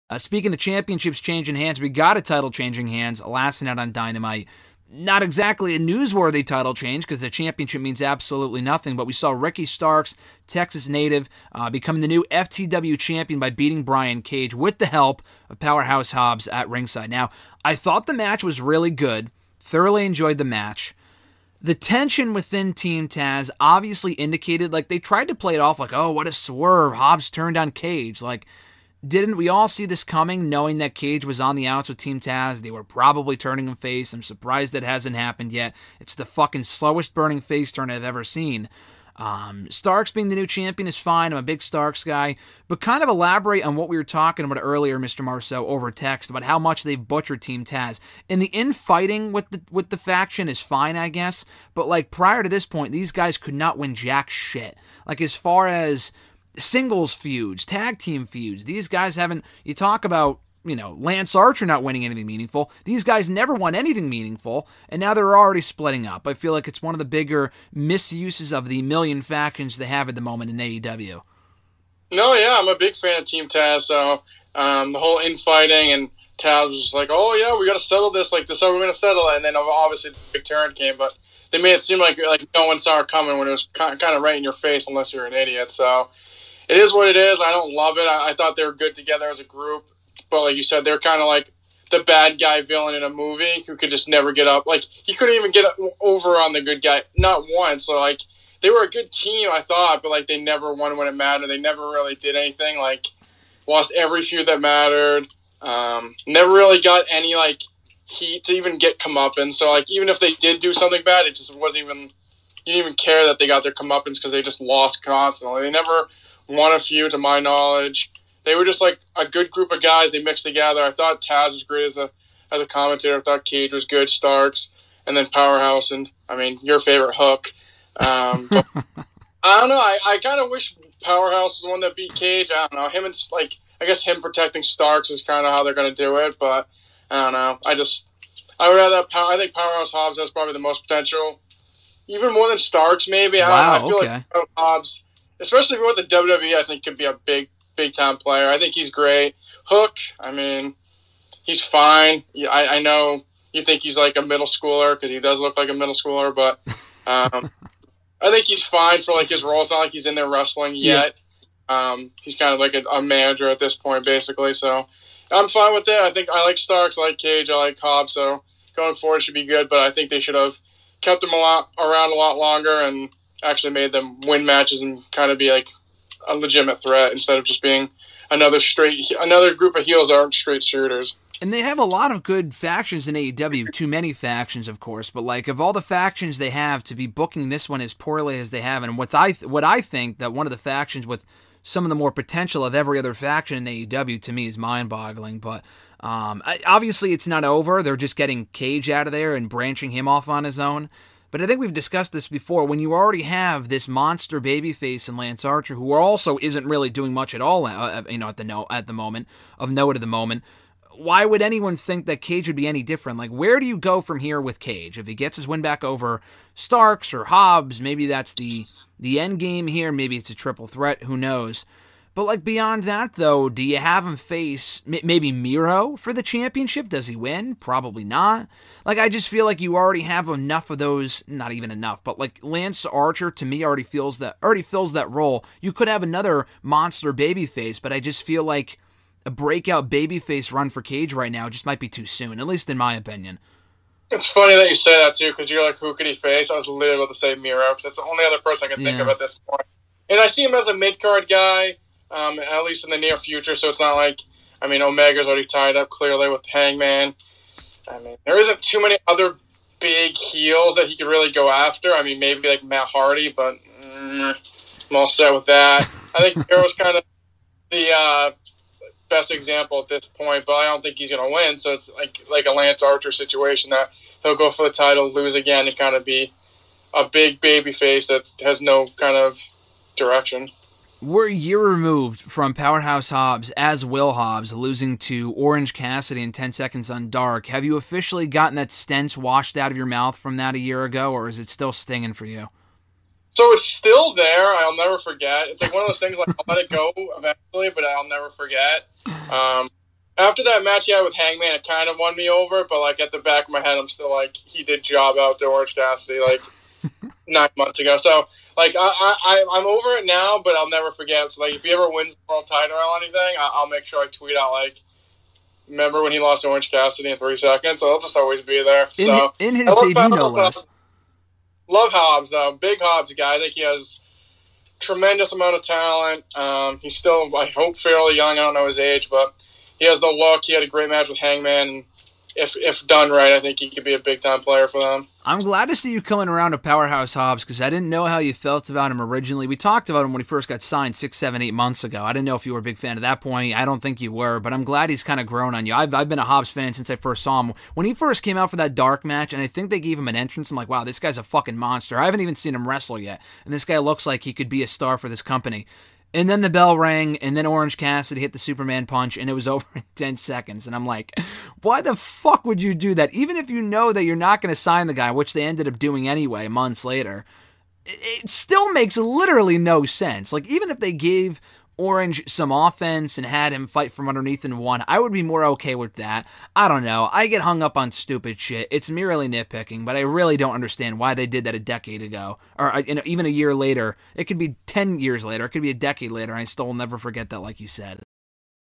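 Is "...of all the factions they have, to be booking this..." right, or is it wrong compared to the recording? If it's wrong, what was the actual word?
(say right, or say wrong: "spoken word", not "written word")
right.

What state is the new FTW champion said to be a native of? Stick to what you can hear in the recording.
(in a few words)
Texas.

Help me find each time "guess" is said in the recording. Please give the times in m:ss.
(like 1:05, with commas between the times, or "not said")
0:51, 2:13.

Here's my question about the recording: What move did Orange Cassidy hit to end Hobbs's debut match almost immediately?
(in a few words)
Superman punch.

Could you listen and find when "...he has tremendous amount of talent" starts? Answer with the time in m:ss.
5:23.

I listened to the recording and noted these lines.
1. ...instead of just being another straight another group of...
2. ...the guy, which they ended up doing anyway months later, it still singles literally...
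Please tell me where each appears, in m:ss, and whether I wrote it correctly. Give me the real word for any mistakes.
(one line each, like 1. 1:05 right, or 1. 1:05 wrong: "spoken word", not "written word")
1. 2:57 right
2. 6:04 wrong: "makes", not "singles".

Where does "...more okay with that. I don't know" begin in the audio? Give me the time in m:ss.
6:15.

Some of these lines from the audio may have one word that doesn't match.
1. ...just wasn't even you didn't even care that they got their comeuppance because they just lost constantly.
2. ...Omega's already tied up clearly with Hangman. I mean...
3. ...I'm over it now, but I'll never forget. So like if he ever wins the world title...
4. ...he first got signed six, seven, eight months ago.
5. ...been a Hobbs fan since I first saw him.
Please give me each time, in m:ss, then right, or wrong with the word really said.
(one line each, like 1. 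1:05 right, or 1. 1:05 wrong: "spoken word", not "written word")
1. 1:51 right
2. 4:14 right
3. 5:09 right
4. 5:40 right
5. 5:46 right.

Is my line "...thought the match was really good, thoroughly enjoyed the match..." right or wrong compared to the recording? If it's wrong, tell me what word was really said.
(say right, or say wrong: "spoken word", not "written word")
right.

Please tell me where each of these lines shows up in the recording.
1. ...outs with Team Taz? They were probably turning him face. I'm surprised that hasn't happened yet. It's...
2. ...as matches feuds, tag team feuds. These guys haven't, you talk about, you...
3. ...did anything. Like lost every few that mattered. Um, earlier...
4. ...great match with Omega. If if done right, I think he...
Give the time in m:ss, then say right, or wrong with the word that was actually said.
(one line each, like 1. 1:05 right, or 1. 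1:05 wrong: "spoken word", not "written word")
1. 0:31 right
2. 0:55 wrong: "singles", not "matches"
3. 1:42 wrong: "never", not "earlier"
4. 5:30 wrong: "Hangman", not "Omega".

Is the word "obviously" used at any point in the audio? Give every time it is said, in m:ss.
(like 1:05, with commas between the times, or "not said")
0:23, 1:19, 3:16.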